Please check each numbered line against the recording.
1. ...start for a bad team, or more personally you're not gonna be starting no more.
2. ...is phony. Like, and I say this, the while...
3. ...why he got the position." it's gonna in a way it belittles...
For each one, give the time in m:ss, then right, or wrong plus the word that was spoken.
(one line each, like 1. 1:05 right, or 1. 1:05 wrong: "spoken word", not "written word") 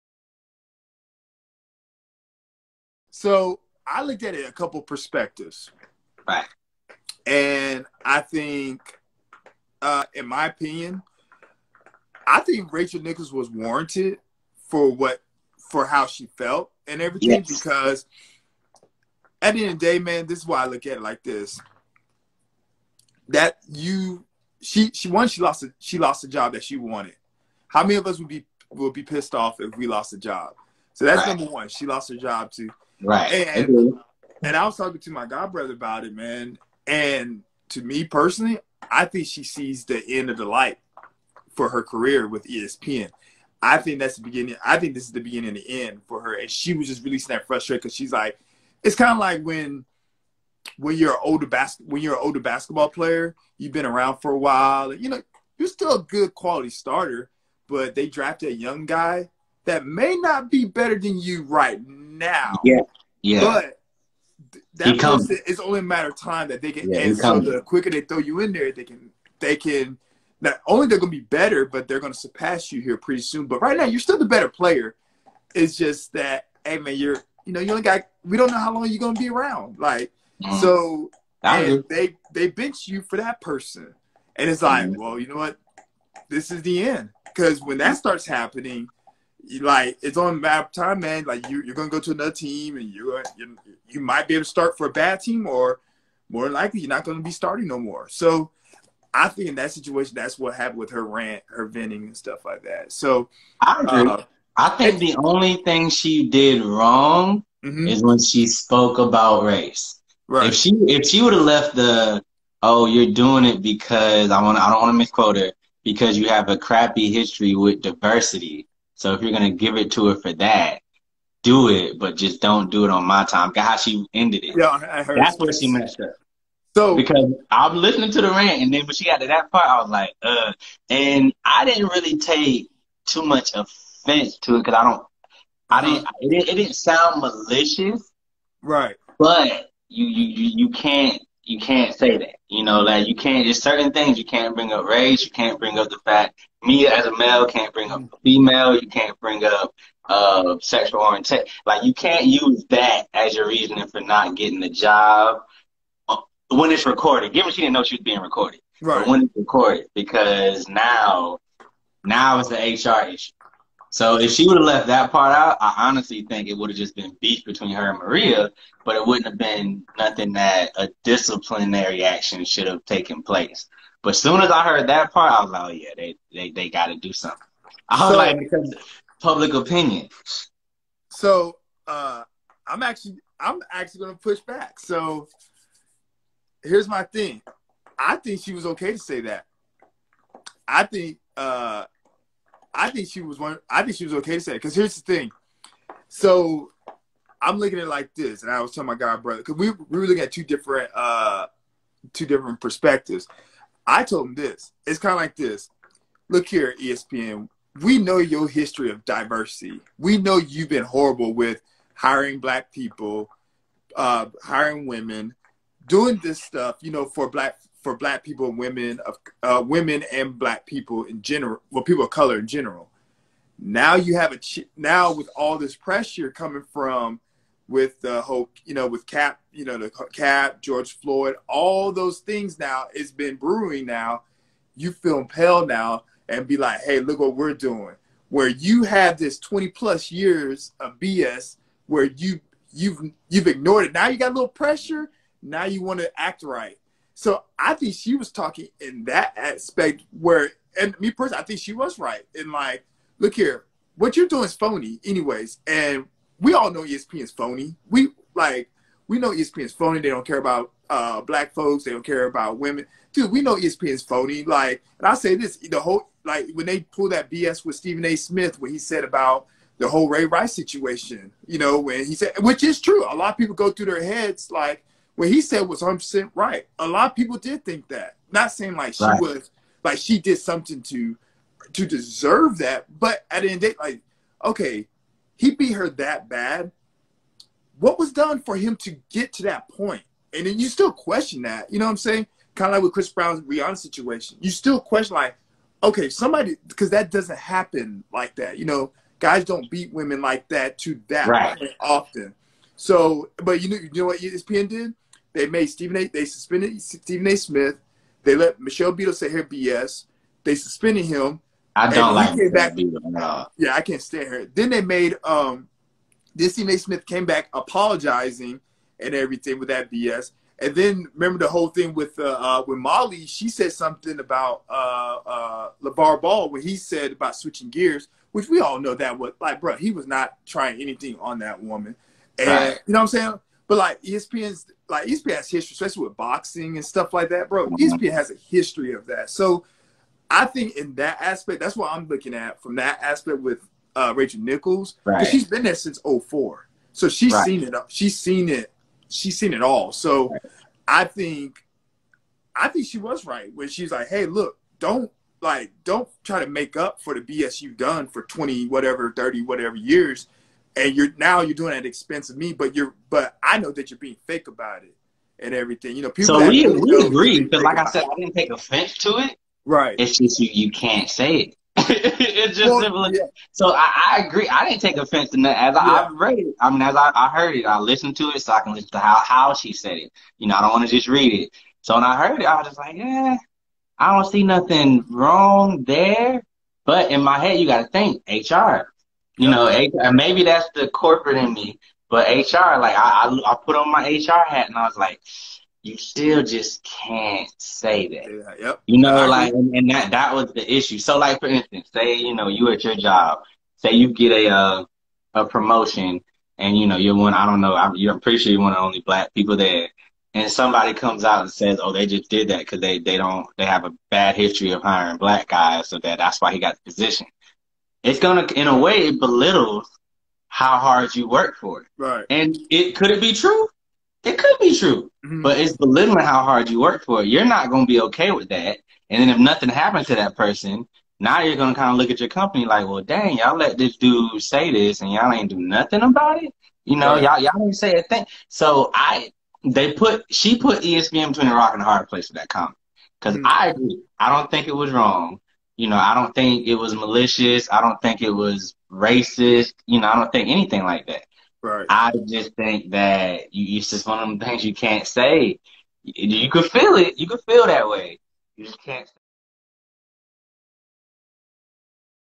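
1. 1:34 wrong: "likely", not "personally"
2. 4:23 wrong: "whole", not "while"
3. 6:56 right.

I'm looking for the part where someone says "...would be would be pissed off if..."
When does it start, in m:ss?
0:28.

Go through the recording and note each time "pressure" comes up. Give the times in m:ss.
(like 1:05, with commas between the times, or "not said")
3:45, 4:04.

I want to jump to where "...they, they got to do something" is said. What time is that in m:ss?
2:56.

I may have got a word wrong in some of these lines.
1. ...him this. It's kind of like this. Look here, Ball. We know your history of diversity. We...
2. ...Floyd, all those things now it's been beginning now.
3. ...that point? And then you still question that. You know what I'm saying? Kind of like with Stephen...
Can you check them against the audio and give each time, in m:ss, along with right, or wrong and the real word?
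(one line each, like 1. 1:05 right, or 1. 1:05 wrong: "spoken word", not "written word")
1. 3:24 wrong: "ESPN", not "Ball"
2. 3:50 wrong: "brewing", not "beginning"
3. 4:49 wrong: "Chris", not "Stephen".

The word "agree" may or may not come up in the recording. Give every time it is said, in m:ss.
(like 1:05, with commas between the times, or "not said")
1:43, 6:07, 6:14, 7:23.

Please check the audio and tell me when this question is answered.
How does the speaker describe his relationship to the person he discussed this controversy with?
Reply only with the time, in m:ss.
0:35.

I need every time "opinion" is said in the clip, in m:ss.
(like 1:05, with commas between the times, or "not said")
0:10, 2:59.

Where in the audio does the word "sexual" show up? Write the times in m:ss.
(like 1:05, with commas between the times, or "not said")
2:30.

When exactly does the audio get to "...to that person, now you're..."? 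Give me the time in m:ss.
7:10.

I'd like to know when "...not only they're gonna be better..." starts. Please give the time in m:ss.
1:10.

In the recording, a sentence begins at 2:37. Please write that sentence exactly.
Given she didn't know she was being recorded, right?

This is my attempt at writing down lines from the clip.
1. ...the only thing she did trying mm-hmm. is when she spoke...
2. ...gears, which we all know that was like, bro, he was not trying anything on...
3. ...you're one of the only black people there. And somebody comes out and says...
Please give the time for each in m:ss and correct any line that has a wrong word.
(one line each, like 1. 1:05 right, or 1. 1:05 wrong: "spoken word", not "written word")
1. 1:44 wrong: "wrong", not "trying"
2. 5:27 right
3. 6:48 right.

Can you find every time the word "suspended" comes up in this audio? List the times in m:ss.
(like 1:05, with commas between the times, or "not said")
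5:06, 5:10.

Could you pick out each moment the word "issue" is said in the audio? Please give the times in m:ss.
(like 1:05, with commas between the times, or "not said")
2:43, 6:40.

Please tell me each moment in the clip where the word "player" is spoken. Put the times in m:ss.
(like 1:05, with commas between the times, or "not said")
0:52, 1:14.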